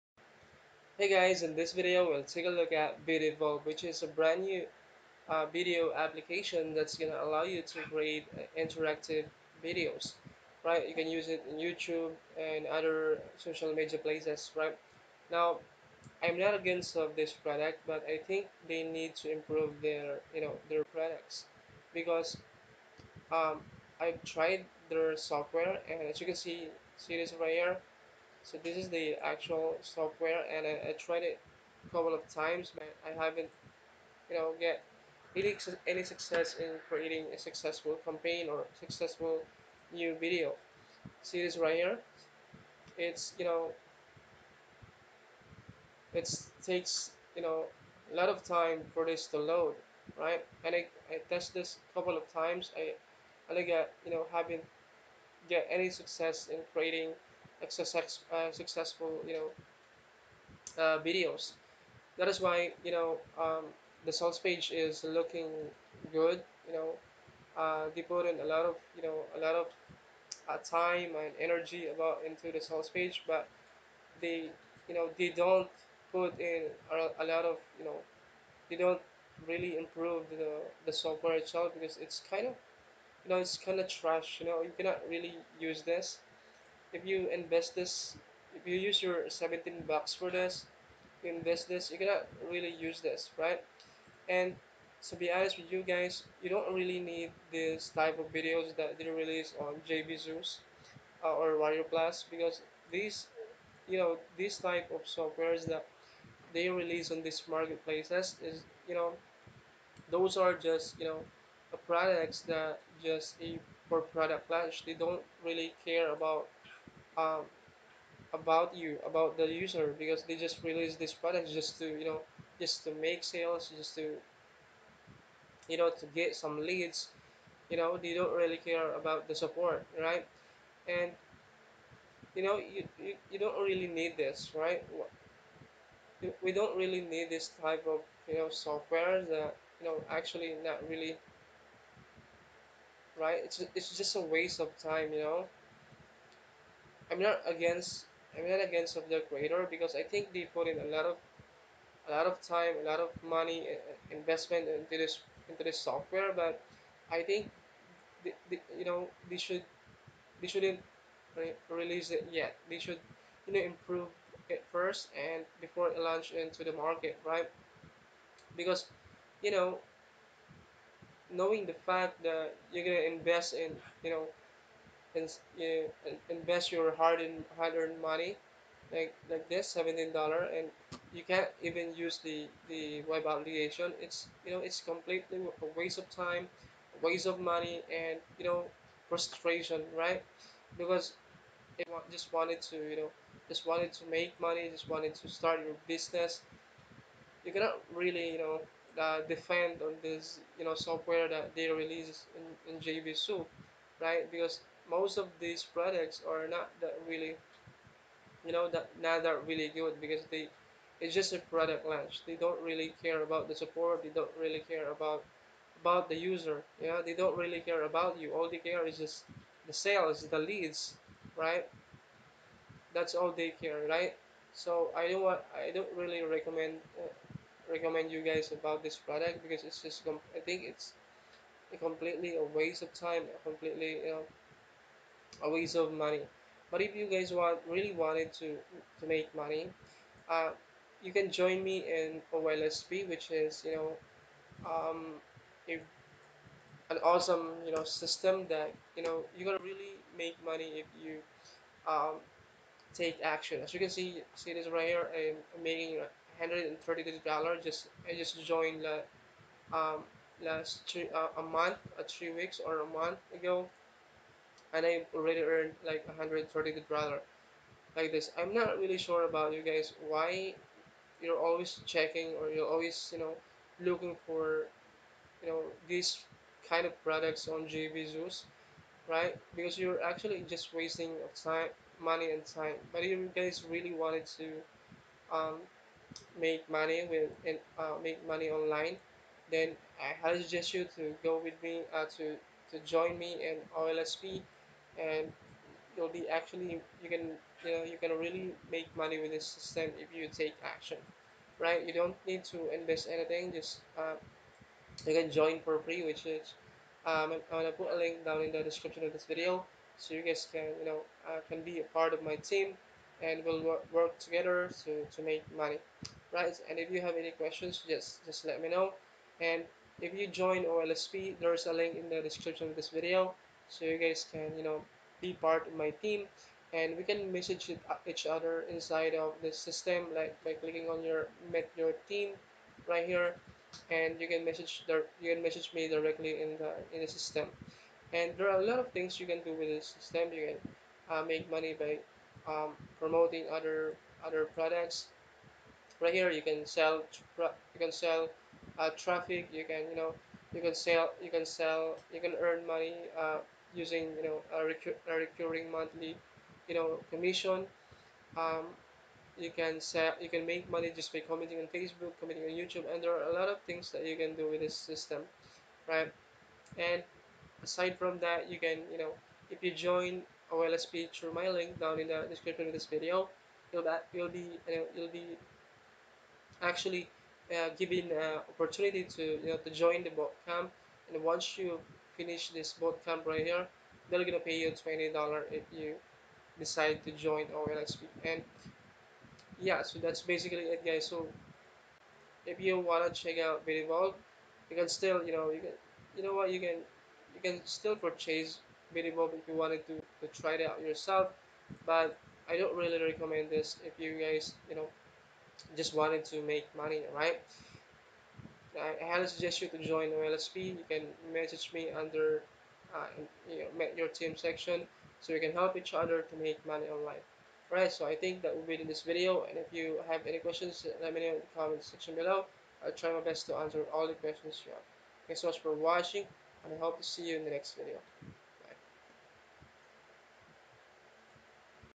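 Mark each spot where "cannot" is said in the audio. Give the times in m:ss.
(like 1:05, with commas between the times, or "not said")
1:24, 1:31, 3:17.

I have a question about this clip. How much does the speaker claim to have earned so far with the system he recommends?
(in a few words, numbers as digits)
$130.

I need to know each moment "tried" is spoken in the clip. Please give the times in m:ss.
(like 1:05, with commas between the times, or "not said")
0:24, 0:30.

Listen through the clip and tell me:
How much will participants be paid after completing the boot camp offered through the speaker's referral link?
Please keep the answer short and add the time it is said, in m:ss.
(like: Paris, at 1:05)
$20, at 6:24.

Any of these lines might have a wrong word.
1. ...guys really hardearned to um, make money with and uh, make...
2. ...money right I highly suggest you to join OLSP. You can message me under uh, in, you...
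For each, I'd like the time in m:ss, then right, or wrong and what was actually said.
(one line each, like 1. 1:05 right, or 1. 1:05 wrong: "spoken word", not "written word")
1. 4:43 wrong: "wanted", not "hardearned"
2. 6:46 right.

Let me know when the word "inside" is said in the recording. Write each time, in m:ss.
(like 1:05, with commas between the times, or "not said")
5:28.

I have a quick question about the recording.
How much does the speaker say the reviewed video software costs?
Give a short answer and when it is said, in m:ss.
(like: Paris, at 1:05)
$17, at 1:29.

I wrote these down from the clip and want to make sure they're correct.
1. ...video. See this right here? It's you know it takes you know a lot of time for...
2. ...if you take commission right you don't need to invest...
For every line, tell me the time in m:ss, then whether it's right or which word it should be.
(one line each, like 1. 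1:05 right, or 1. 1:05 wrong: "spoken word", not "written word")
1. 0:40 right
2. 4:59 wrong: "action", not "commission".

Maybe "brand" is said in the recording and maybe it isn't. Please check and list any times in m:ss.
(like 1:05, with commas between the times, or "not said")
0:04.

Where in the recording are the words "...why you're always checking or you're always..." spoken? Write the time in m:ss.
4:30.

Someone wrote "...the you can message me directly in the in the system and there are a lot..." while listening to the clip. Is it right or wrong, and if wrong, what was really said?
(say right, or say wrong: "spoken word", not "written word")
right.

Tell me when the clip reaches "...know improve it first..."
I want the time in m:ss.
2:43.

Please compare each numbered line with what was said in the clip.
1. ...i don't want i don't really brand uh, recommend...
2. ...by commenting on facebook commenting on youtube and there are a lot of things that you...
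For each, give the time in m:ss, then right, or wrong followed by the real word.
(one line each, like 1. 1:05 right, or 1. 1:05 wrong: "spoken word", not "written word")
1. 3:44 wrong: "recommend", not "brand"
2. 6:01 right.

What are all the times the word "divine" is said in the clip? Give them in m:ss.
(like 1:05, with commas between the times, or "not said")
not said.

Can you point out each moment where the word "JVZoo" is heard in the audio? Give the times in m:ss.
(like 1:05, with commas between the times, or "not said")
1:39, 3:22, 4:37.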